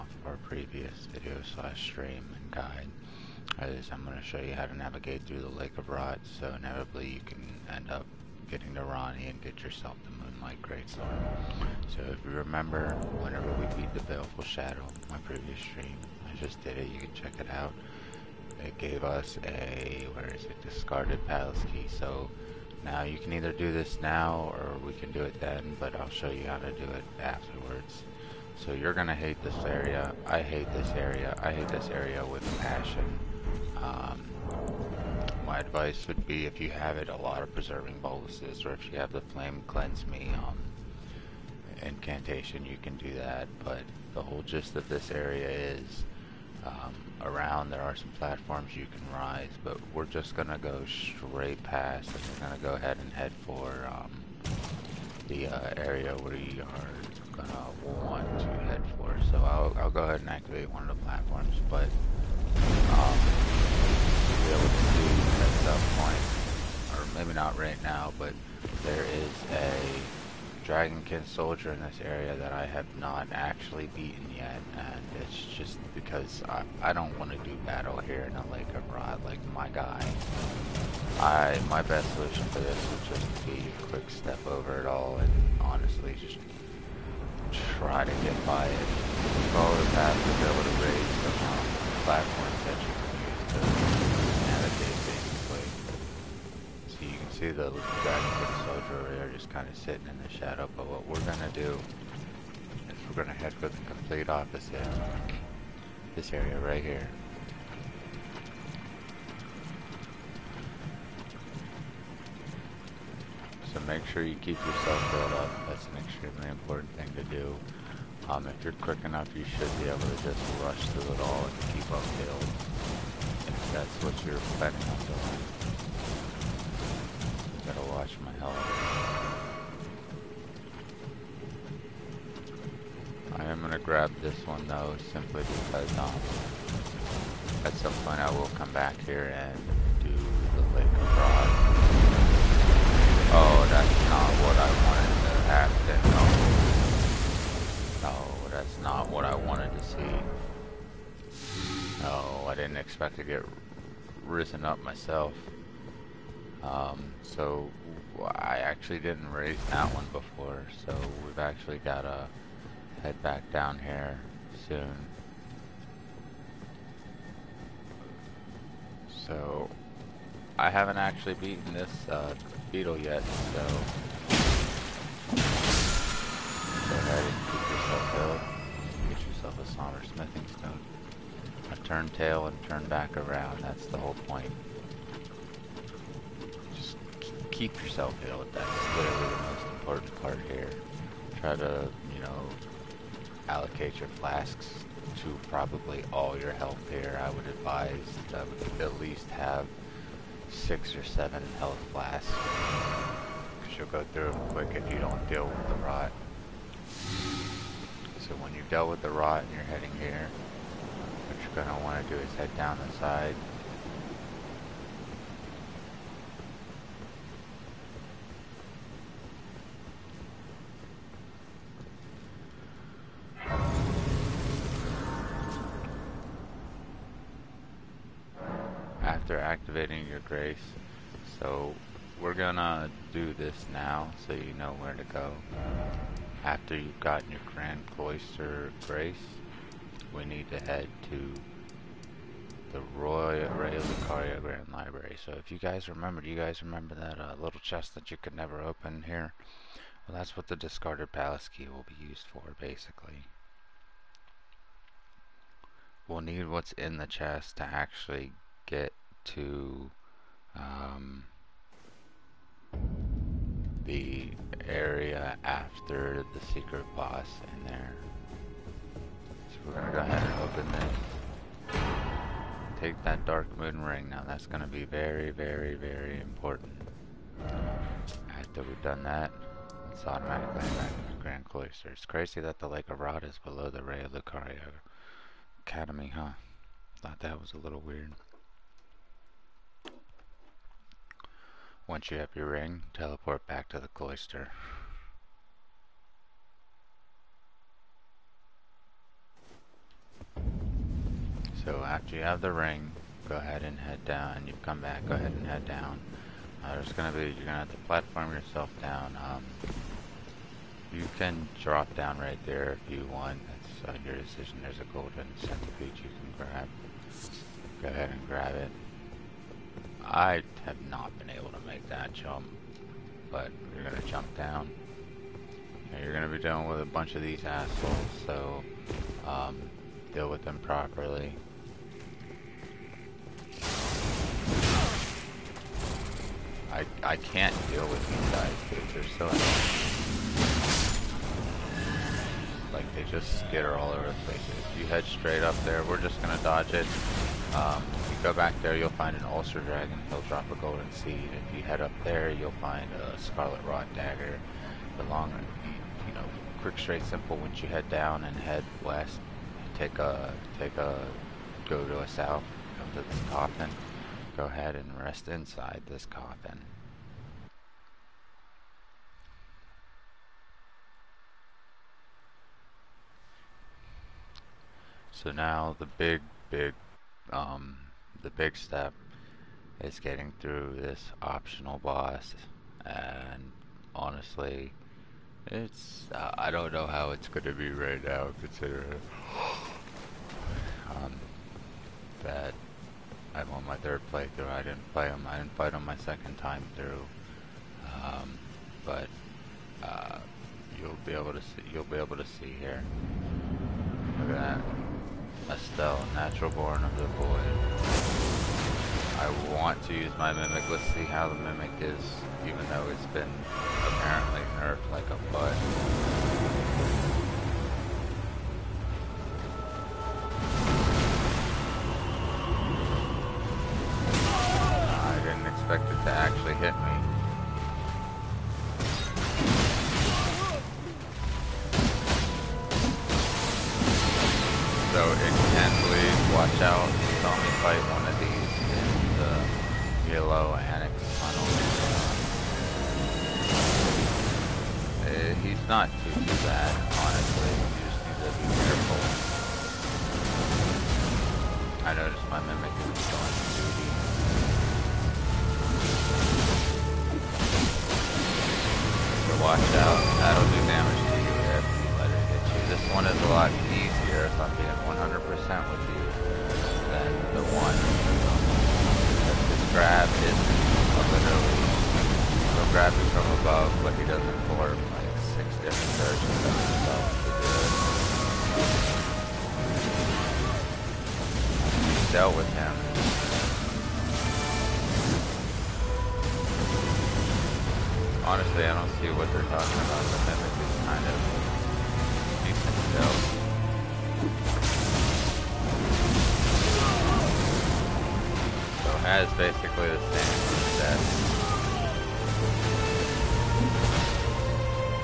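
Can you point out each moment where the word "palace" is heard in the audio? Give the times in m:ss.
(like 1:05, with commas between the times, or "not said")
0:21, 4:11.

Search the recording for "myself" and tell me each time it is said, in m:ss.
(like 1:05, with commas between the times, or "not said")
2:34.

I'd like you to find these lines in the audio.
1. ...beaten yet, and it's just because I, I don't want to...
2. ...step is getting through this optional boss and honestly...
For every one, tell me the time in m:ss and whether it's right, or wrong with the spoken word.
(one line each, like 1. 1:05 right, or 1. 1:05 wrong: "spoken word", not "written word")
1. 1:13 right
2. 6:18 right.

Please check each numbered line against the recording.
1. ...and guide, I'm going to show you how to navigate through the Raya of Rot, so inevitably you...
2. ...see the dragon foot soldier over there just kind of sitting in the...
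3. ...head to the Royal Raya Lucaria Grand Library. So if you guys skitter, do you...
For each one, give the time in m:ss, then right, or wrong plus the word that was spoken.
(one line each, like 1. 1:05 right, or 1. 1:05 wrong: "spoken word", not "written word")
1. 0:02 wrong: "Lake", not "Raya"
2. 1:37 right
3. 4:00 wrong: "remember", not "skitter".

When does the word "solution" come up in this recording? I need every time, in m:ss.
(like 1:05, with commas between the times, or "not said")
1:22.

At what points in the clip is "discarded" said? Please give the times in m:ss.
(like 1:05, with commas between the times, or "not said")
0:20, 4:10.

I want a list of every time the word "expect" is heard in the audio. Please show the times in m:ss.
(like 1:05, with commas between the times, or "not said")
2:32, 7:05.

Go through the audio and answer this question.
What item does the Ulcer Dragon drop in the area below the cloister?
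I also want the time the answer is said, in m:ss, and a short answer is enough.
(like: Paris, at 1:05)
Golden Seed, at 5:50.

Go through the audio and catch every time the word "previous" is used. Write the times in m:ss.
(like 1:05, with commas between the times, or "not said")
0:00, 0:15.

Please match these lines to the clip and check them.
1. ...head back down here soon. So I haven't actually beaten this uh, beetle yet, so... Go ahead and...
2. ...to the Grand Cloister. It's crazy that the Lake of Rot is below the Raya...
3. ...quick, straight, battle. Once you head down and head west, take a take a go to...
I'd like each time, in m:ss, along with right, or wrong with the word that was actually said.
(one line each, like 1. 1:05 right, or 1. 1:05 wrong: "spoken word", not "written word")
1. 2:43 right
2. 4:40 right
3. 5:56 wrong: "simple", not "battle".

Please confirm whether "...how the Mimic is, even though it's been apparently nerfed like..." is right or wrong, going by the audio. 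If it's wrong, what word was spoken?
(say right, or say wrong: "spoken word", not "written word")
right.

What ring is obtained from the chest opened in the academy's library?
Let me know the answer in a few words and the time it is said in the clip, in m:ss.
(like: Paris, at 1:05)
Dark moon ring, at 4:33.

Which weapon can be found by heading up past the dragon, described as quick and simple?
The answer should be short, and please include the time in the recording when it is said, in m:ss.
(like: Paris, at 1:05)
Scarlet Rod Dagger, at 5:53.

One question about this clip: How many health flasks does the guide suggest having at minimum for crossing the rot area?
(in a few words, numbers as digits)
6 or 7.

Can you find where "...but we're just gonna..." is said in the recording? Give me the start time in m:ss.
0:49.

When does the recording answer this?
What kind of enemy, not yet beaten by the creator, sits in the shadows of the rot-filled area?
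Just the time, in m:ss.
1:10.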